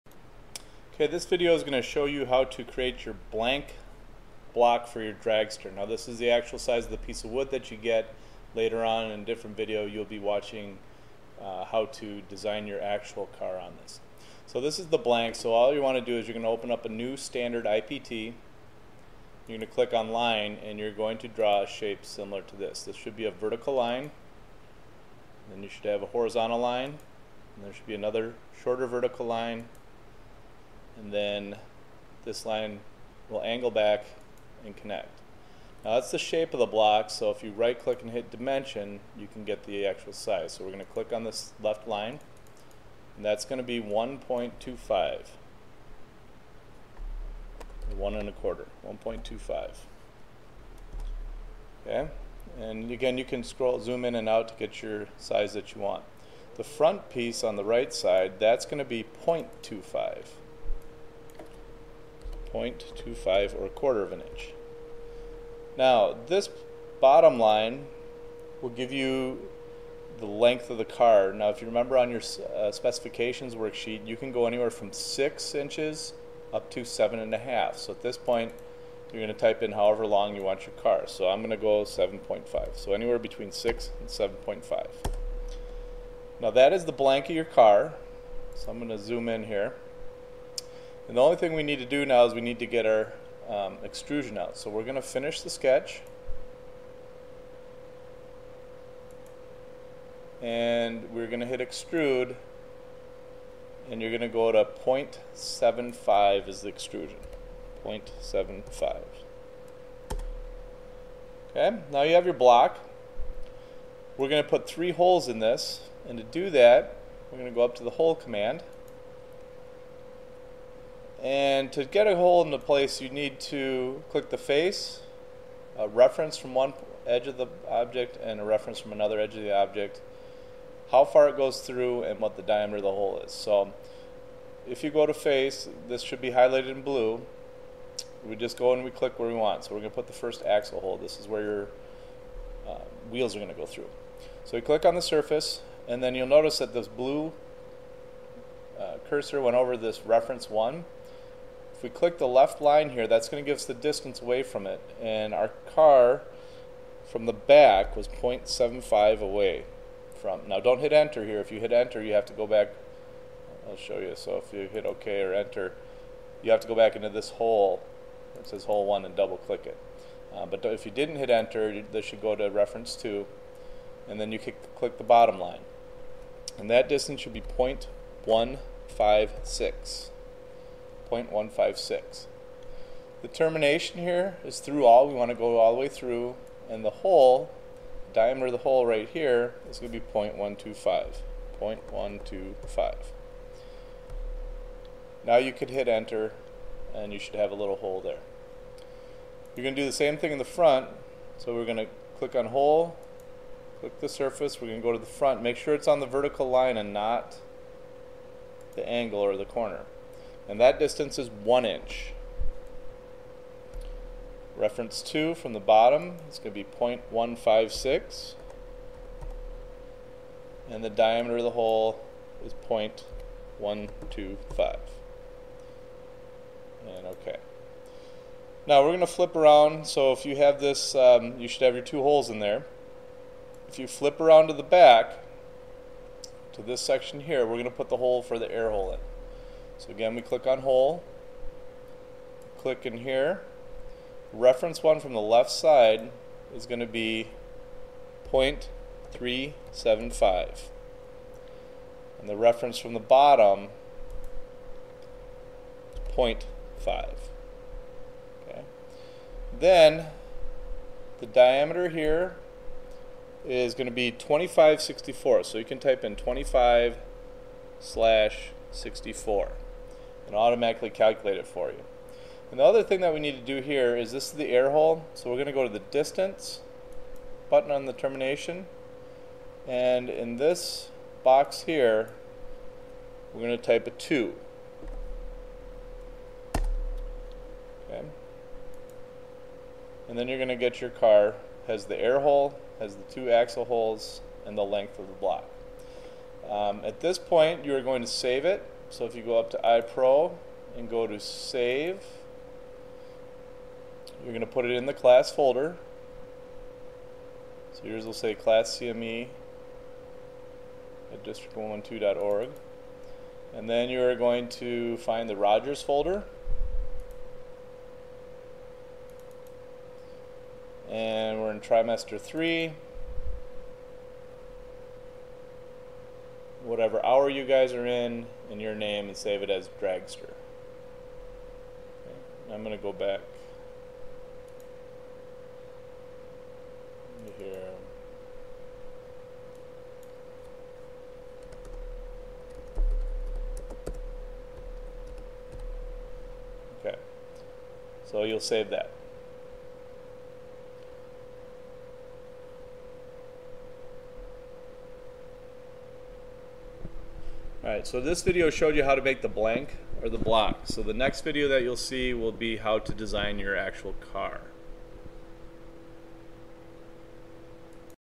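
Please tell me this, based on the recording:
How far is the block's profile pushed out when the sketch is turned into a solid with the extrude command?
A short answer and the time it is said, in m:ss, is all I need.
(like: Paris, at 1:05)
0.75, at 1:44.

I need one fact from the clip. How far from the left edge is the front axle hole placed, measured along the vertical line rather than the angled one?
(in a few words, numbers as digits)
one inch.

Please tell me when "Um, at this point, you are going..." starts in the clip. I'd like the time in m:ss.
4:56.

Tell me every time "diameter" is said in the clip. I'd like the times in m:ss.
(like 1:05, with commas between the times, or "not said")
2:12, 3:08, 3:40, 4:21.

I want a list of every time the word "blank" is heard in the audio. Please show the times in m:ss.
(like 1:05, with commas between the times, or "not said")
0:03, 0:14, 1:26, 5:59.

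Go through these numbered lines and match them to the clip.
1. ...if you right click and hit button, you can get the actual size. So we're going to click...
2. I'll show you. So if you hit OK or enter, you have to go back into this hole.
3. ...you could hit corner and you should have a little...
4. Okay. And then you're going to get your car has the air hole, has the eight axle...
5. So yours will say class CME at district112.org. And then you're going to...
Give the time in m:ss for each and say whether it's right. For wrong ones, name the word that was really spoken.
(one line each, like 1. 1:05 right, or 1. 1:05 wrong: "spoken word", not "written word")
1. 0:37 wrong: "dimension", not "button"
2. 2:43 right
3. 3:15 wrong: "enter", not "corner"
4. 4:46 wrong: "two", not "eight"
5. 5:07 right.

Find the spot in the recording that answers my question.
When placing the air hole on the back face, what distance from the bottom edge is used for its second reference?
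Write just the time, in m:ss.
4:16.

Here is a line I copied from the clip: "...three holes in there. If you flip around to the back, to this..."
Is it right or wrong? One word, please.
wrong.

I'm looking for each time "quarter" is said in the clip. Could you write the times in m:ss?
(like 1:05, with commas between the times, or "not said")
0:48, 1:03.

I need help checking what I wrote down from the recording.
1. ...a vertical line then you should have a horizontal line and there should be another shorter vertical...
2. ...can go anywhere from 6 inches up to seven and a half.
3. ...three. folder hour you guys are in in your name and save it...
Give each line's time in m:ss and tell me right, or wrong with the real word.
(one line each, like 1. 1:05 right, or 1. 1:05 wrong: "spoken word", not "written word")
1. 0:23 right
2. 1:14 right
3. 5:22 wrong: "whatever", not "folder".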